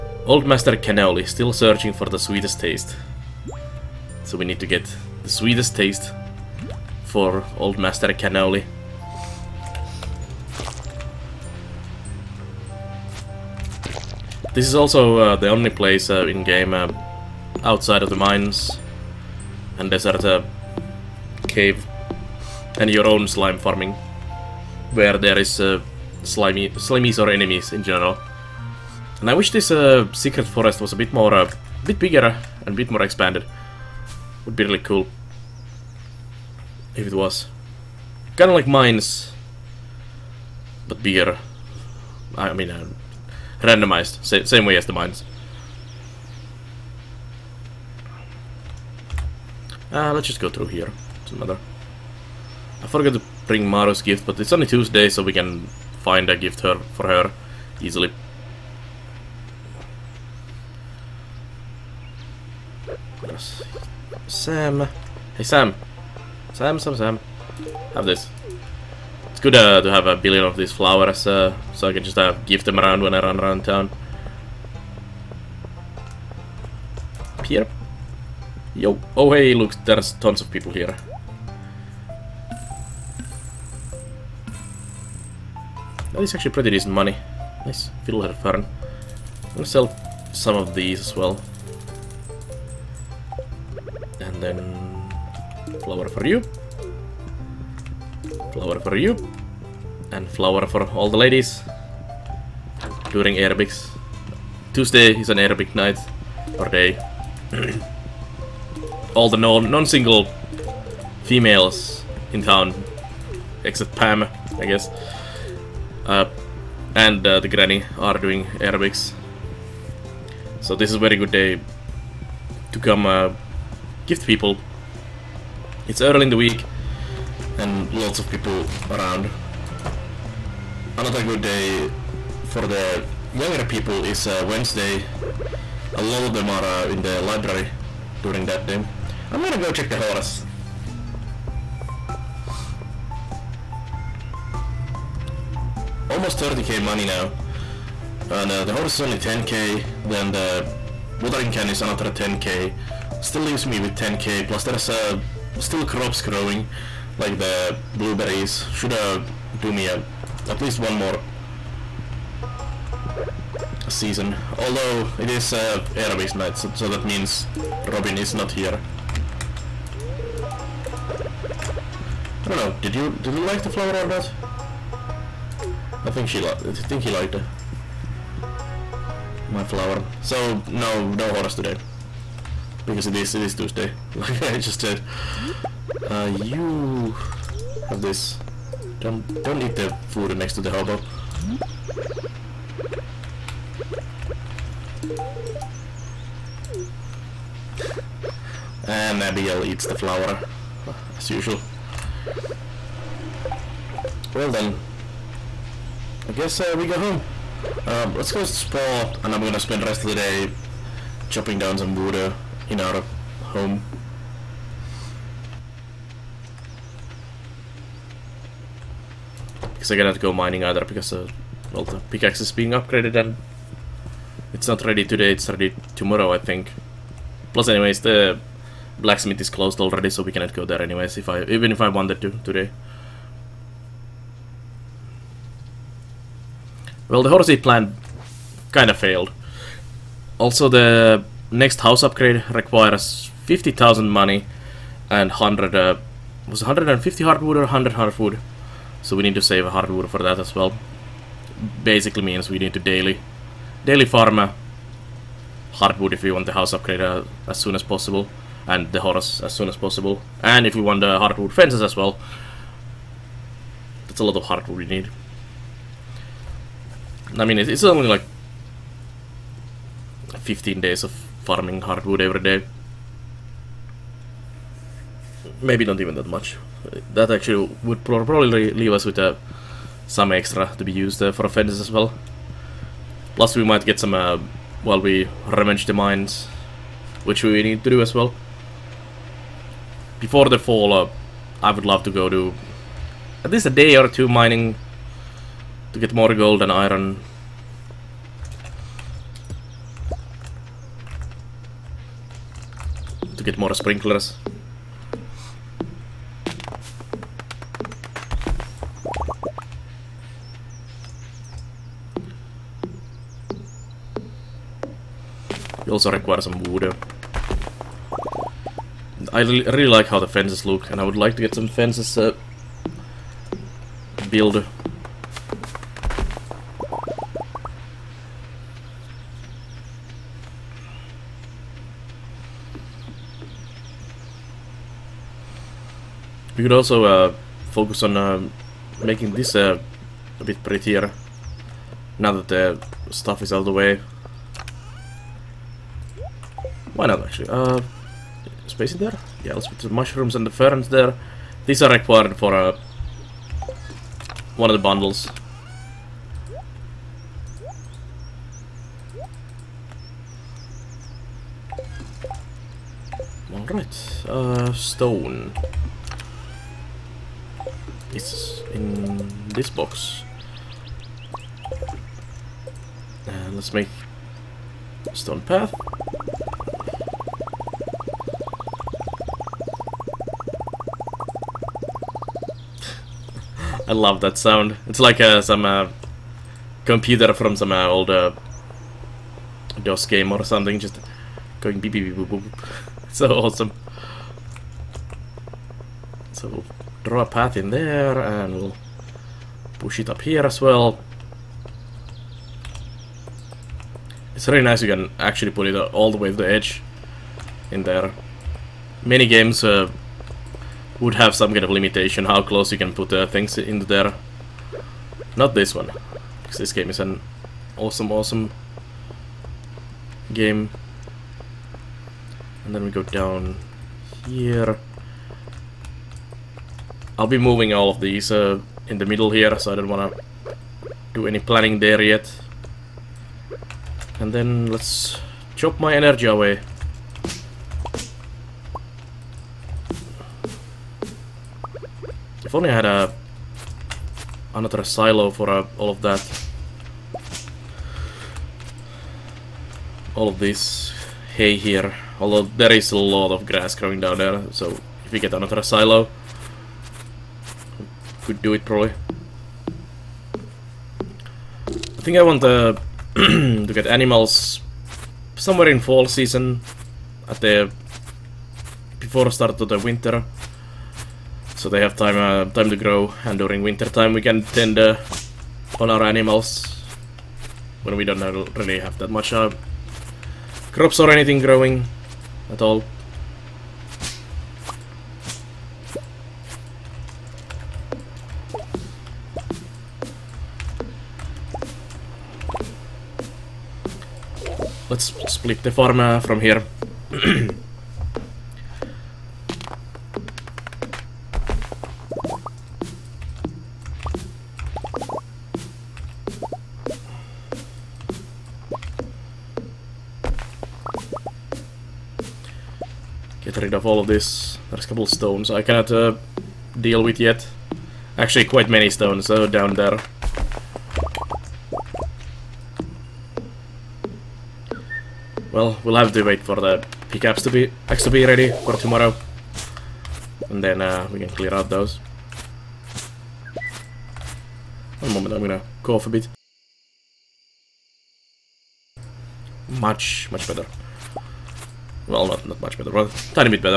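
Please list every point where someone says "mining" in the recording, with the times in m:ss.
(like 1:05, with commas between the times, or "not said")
3:40, 4:54.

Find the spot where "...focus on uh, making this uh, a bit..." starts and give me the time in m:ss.
5:37.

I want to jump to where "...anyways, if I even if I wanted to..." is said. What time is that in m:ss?
3:50.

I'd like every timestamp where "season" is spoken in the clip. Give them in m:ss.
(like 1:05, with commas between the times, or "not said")
2:43, 7:46.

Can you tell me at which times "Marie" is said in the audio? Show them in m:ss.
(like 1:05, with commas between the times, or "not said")
not said.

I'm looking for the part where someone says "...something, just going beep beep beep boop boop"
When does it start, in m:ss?
6:30.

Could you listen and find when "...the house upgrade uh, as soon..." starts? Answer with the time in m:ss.
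4:16.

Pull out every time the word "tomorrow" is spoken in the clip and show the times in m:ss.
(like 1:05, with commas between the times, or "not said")
3:45, 8:48.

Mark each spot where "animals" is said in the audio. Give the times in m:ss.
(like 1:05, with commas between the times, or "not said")
7:43, 7:56.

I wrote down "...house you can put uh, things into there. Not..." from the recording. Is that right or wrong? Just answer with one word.
wrong.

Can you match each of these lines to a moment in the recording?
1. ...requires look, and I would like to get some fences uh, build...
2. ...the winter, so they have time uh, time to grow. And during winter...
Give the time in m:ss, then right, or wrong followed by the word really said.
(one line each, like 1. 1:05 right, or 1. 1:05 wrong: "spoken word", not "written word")
1. 5:20 wrong: "fences", not "requires"
2. 7:49 right.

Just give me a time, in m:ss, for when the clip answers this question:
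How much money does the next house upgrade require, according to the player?
4:03.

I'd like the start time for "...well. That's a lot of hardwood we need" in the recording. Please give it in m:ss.
4:21.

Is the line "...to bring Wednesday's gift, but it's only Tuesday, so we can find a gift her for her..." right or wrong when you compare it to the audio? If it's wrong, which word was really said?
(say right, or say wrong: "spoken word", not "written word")
wrong: "Maru", not "Wednesday".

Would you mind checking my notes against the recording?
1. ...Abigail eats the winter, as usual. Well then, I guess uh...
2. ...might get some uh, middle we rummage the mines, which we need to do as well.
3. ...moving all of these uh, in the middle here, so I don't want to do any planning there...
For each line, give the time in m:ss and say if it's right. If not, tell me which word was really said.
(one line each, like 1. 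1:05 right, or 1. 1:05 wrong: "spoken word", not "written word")
1. 3:19 wrong: "flower", not "winter"
2. 4:43 wrong: "while", not "middle"
3. 7:07 right.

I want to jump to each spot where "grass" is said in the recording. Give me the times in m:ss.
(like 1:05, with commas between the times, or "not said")
7:33.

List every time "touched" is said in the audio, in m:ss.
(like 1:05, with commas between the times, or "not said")
not said.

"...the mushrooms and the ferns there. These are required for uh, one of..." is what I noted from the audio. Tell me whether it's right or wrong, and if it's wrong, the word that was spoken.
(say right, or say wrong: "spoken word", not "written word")
right.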